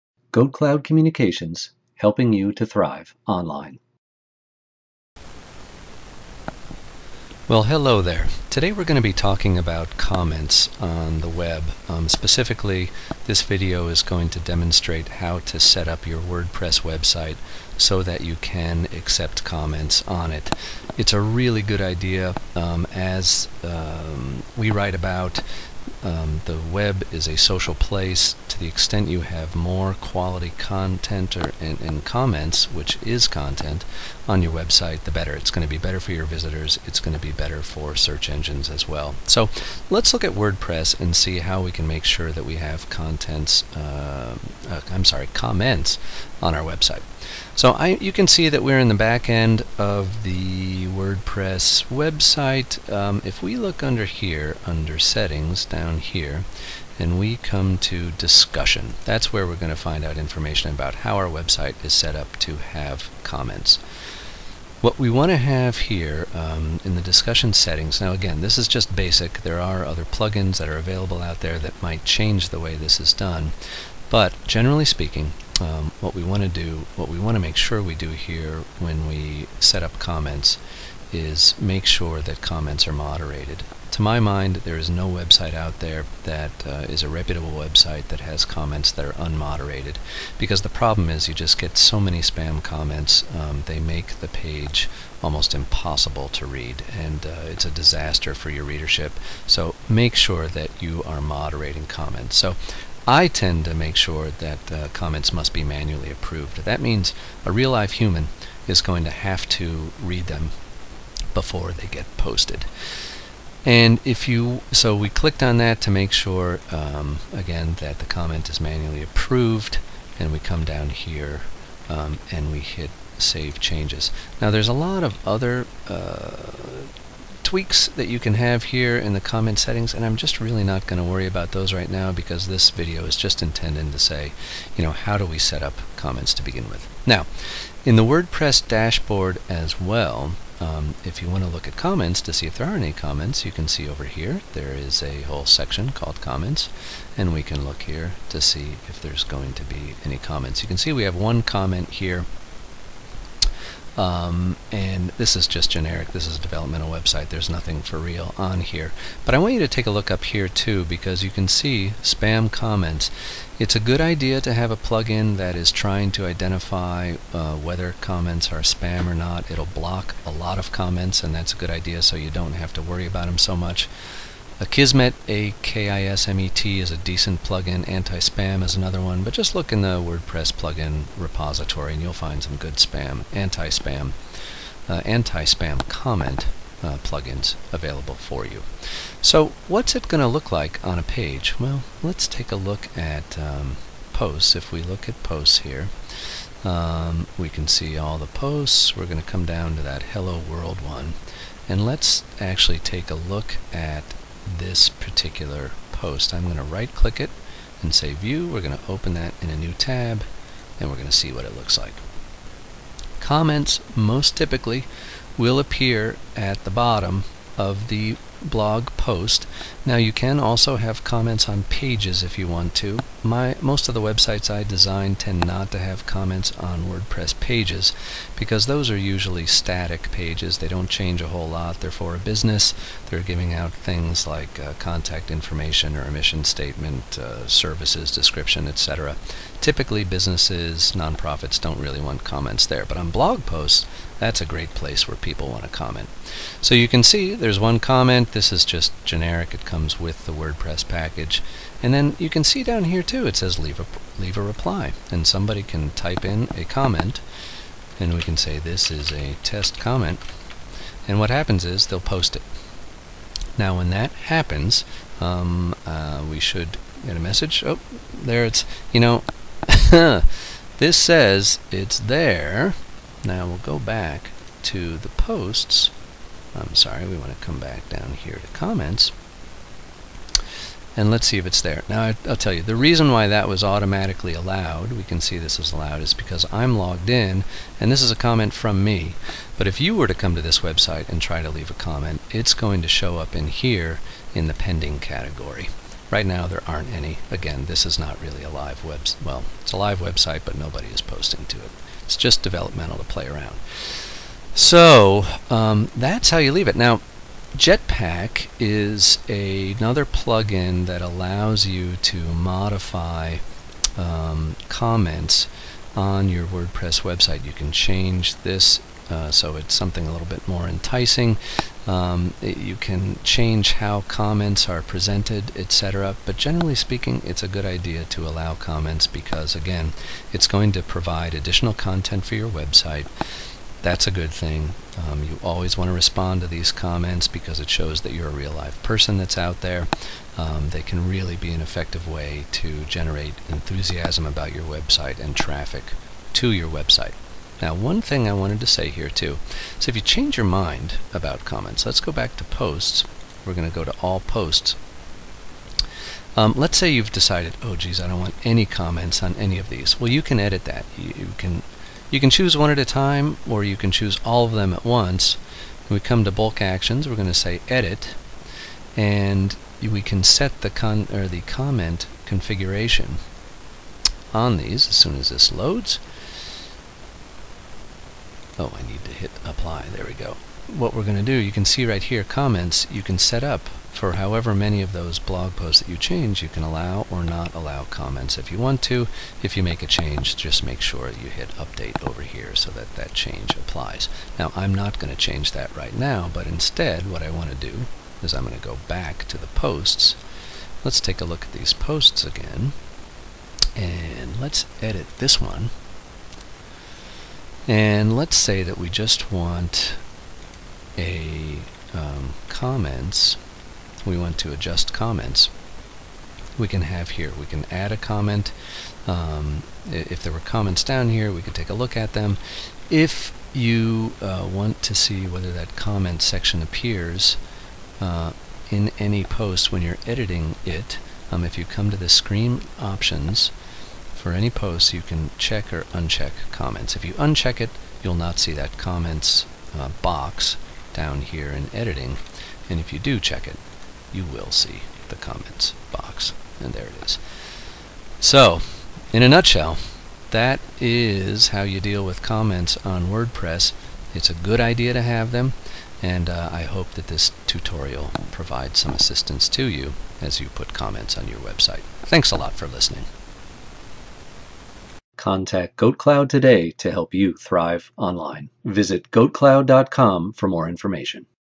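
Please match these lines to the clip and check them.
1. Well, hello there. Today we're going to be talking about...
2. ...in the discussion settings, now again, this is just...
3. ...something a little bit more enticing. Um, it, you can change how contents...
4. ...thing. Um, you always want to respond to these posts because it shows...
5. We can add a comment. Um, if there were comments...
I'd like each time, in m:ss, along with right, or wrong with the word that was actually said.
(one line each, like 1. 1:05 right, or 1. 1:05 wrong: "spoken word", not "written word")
1. 0:07 right
2. 1:06 right
3. 5:19 wrong: "comments", not "contents"
4. 5:34 wrong: "comments", not "posts"
5. 6:57 right.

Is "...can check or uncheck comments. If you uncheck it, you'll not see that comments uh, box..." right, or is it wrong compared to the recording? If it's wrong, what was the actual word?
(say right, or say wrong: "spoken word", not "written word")
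right.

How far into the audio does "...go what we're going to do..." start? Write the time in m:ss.
6:20.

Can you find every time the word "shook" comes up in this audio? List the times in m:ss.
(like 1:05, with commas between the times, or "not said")
not said.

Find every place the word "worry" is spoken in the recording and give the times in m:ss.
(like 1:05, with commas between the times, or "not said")
2:11, 2:52.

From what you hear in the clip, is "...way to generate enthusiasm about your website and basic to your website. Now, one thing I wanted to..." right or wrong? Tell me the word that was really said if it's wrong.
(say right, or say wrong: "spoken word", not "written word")
wrong: "traffic", not "basic".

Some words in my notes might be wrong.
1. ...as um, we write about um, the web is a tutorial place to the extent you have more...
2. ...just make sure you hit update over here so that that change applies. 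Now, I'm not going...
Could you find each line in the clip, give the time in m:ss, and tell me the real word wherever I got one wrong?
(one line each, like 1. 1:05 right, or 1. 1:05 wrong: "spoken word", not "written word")
1. 0:22 wrong: "social", not "tutorial"
2. 6:30 right.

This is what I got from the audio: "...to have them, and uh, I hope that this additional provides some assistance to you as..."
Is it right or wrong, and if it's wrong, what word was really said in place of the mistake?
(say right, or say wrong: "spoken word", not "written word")
wrong: "tutorial", not "additional".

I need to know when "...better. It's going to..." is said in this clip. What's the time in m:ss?
0:35.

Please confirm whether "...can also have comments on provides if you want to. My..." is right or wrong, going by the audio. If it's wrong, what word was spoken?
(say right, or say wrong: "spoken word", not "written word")
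wrong: "pages", not "provides".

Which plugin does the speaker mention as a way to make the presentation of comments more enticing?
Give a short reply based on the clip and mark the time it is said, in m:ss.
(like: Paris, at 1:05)
Jetpack, at 5:07.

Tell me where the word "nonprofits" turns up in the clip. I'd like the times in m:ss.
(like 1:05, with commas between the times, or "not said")
4:00.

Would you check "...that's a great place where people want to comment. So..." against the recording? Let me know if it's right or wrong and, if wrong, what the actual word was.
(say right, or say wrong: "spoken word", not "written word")
right.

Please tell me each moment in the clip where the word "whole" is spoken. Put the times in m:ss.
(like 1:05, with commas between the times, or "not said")
2:25, 3:51.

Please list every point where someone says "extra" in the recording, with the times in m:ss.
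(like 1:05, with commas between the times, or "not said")
not said.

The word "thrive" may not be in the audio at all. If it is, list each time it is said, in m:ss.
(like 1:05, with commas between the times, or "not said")
0:02, 7:47.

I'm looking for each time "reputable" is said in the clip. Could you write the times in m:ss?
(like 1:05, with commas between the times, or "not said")
1:27.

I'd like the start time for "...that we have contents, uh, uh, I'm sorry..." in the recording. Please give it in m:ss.
0:42.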